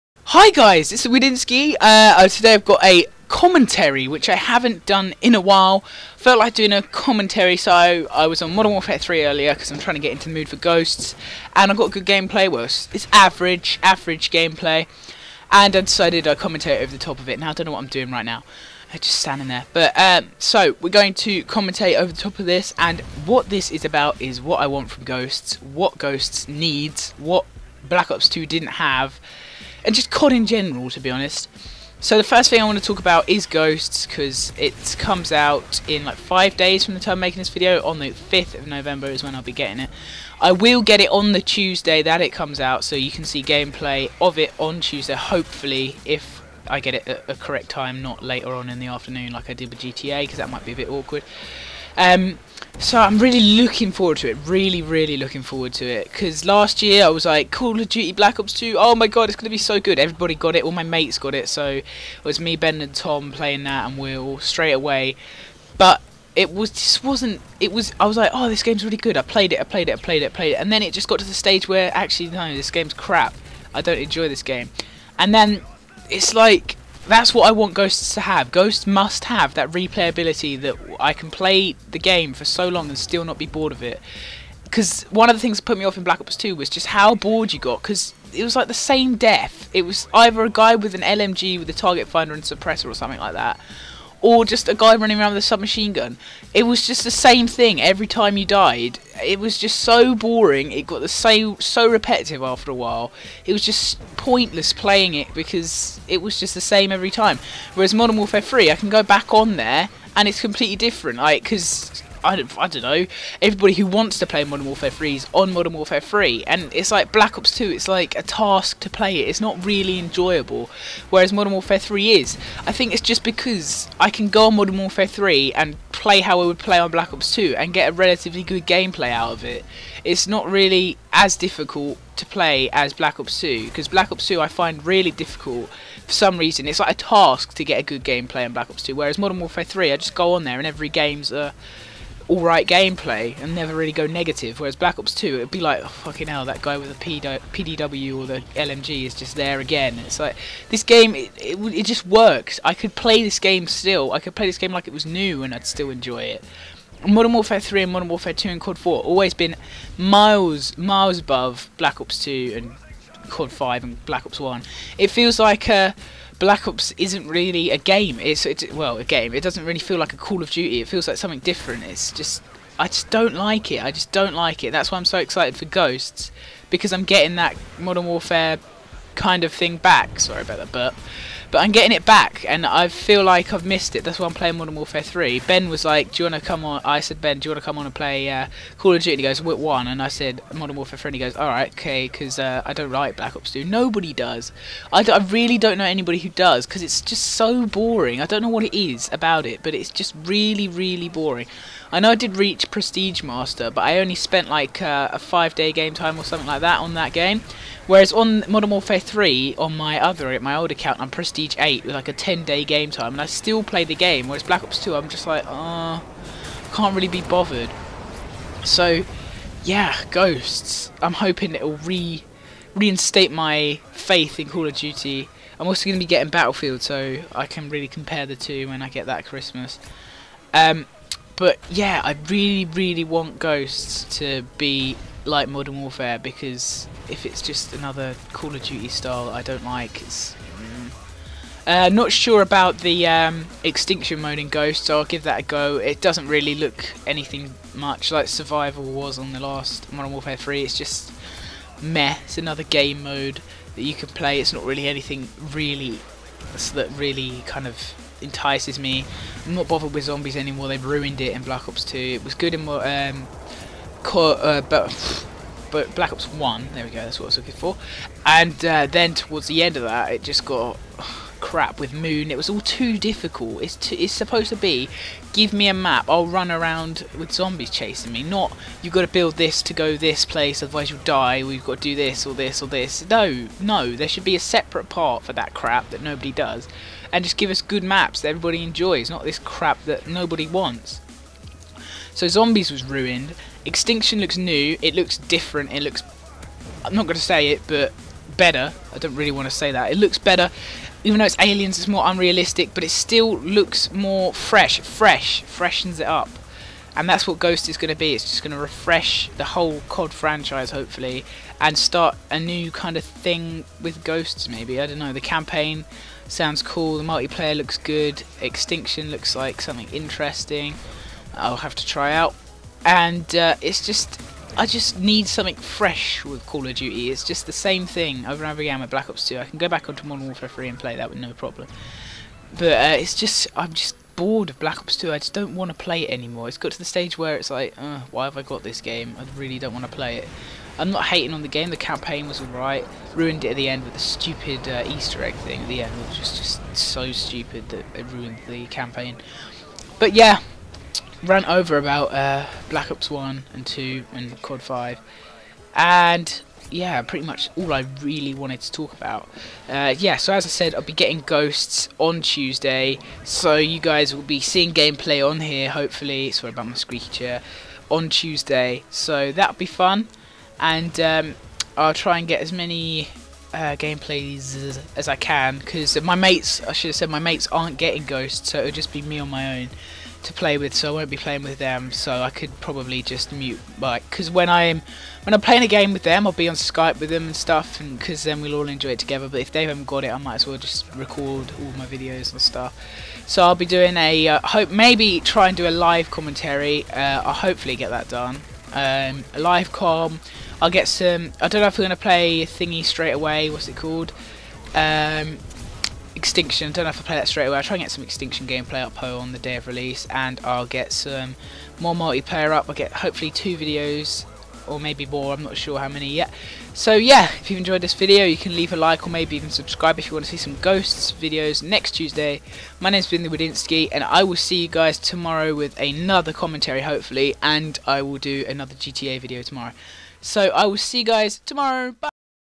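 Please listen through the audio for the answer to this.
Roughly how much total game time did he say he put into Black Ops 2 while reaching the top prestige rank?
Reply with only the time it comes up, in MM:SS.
03:25.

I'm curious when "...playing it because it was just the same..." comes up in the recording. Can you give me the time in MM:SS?
01:44.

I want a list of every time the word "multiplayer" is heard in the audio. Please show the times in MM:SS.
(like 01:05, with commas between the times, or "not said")
05:17, 06:51.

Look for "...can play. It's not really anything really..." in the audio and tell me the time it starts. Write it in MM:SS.
04:13.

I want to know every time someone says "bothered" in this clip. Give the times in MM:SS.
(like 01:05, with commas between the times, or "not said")
03:37, 04:19.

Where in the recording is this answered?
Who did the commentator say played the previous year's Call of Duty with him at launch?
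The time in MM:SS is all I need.
01:02.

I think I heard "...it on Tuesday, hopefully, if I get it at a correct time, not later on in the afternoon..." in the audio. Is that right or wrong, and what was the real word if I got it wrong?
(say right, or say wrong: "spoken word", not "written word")
right.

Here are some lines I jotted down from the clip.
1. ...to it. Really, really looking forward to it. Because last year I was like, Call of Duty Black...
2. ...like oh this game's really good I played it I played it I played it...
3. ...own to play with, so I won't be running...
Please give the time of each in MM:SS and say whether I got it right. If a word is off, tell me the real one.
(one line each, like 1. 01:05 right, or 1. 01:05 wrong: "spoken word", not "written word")
1. 00:54 right
2. 01:08 right
3. 06:19 wrong: "playing", not "running".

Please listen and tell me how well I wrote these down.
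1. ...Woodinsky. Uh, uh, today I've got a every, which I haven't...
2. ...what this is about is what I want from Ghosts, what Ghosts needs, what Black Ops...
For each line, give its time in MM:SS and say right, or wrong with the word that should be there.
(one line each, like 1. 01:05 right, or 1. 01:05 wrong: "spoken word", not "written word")
1. 00:01 wrong: "commentary", not "every"
2. 00:23 right.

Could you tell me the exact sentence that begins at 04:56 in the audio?
I'm not going to say it, but better.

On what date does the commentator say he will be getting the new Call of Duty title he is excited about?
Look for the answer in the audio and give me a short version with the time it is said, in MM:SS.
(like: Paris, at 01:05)
5th of November, at 00:38.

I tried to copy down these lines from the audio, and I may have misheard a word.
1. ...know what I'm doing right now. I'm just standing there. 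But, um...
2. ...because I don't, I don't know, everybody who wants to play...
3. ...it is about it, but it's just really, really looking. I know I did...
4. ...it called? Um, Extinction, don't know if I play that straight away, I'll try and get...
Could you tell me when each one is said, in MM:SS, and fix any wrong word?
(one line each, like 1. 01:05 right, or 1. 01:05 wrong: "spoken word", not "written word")
1. 00:17 right
2. 01:51 right
3. 03:18 wrong: "boring", not "looking"
4. 06:43 right.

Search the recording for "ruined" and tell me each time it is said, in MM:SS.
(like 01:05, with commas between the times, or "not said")
04:20, 04:52, 05:43, 05:48.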